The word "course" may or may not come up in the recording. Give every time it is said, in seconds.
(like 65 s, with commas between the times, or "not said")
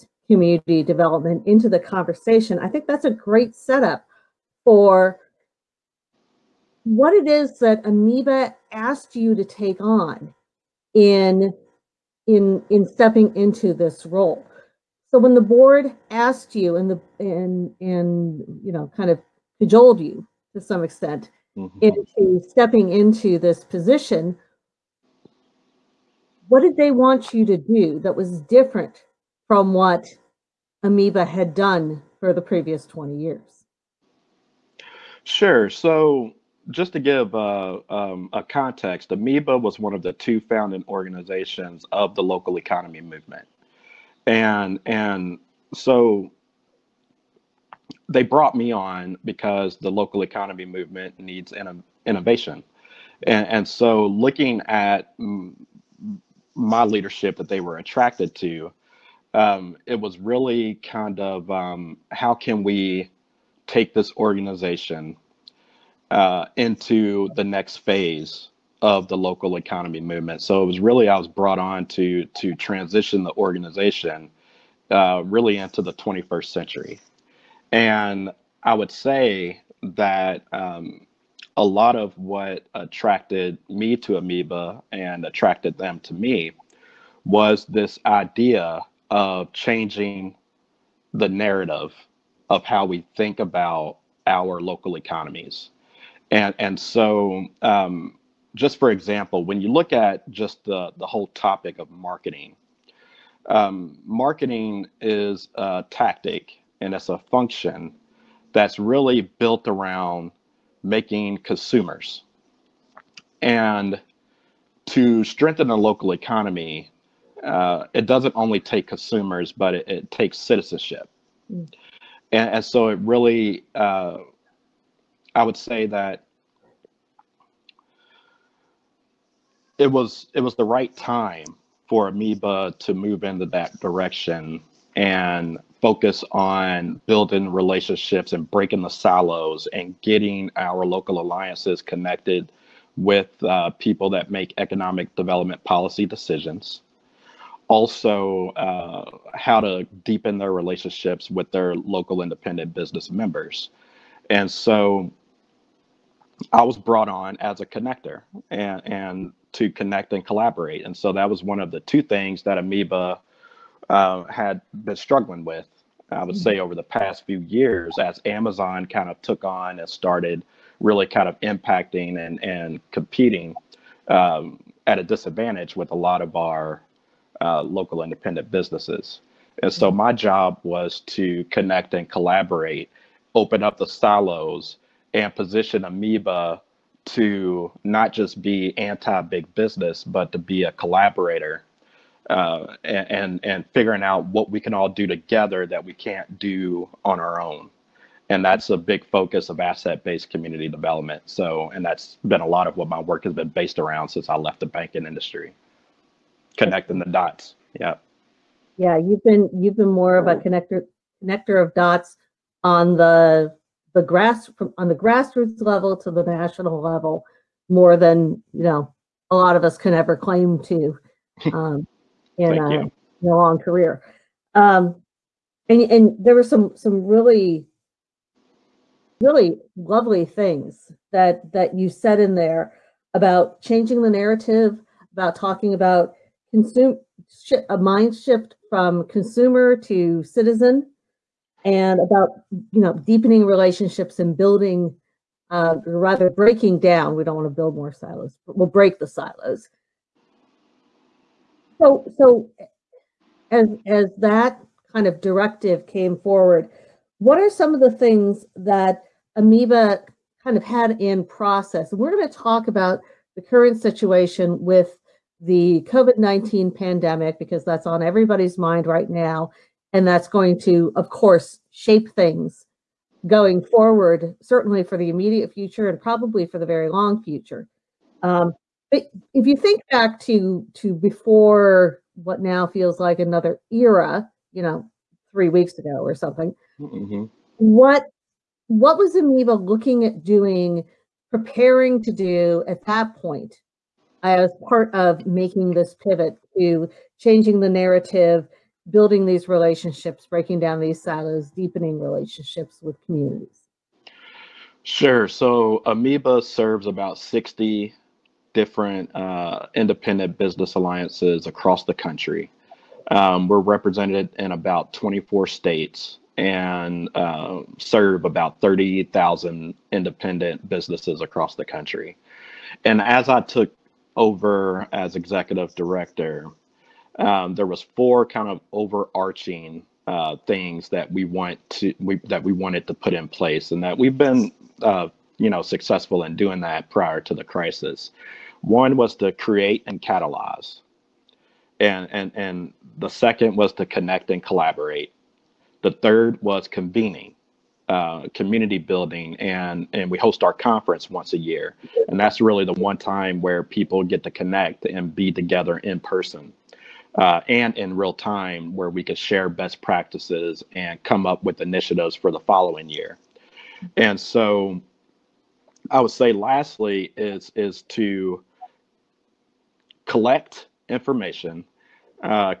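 271 s.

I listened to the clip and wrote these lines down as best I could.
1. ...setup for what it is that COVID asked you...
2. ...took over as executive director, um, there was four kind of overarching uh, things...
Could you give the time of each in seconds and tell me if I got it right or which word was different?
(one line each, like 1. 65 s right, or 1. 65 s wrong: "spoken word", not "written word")
1. 3 s wrong: "AMIBA", not "COVID"
2. 323 s right.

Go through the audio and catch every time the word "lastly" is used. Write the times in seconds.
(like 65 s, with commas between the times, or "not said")
366 s.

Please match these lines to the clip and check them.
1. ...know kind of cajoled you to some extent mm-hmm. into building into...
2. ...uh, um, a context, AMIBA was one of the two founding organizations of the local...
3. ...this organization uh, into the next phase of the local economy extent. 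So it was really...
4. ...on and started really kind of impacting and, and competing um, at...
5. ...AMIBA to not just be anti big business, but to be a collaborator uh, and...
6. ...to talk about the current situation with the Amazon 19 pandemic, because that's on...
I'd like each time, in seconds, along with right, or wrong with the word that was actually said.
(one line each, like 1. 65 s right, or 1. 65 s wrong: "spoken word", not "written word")
1. 18 s wrong: "stepping", not "building"
2. 37 s right
3. 63 s wrong: "movement", not "extent"
4. 169 s right
5. 185 s right
6. 262 s wrong: "COVID", not "Amazon".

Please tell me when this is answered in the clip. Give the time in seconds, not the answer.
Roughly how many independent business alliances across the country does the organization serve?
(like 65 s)
307 s.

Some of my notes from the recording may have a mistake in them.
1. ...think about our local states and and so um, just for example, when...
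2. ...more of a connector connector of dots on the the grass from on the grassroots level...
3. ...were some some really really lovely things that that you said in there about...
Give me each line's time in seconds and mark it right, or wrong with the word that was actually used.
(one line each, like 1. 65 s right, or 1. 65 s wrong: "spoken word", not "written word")
1. 93 s wrong: "economies", not "states"
2. 209 s right
3. 226 s right.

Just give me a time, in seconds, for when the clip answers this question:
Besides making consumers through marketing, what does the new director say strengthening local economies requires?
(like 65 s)
120 s.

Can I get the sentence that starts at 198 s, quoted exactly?
And that's a big focus of asset-based community development.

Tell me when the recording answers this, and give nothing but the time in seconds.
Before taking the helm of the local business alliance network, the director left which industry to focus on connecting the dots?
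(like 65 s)
204 s.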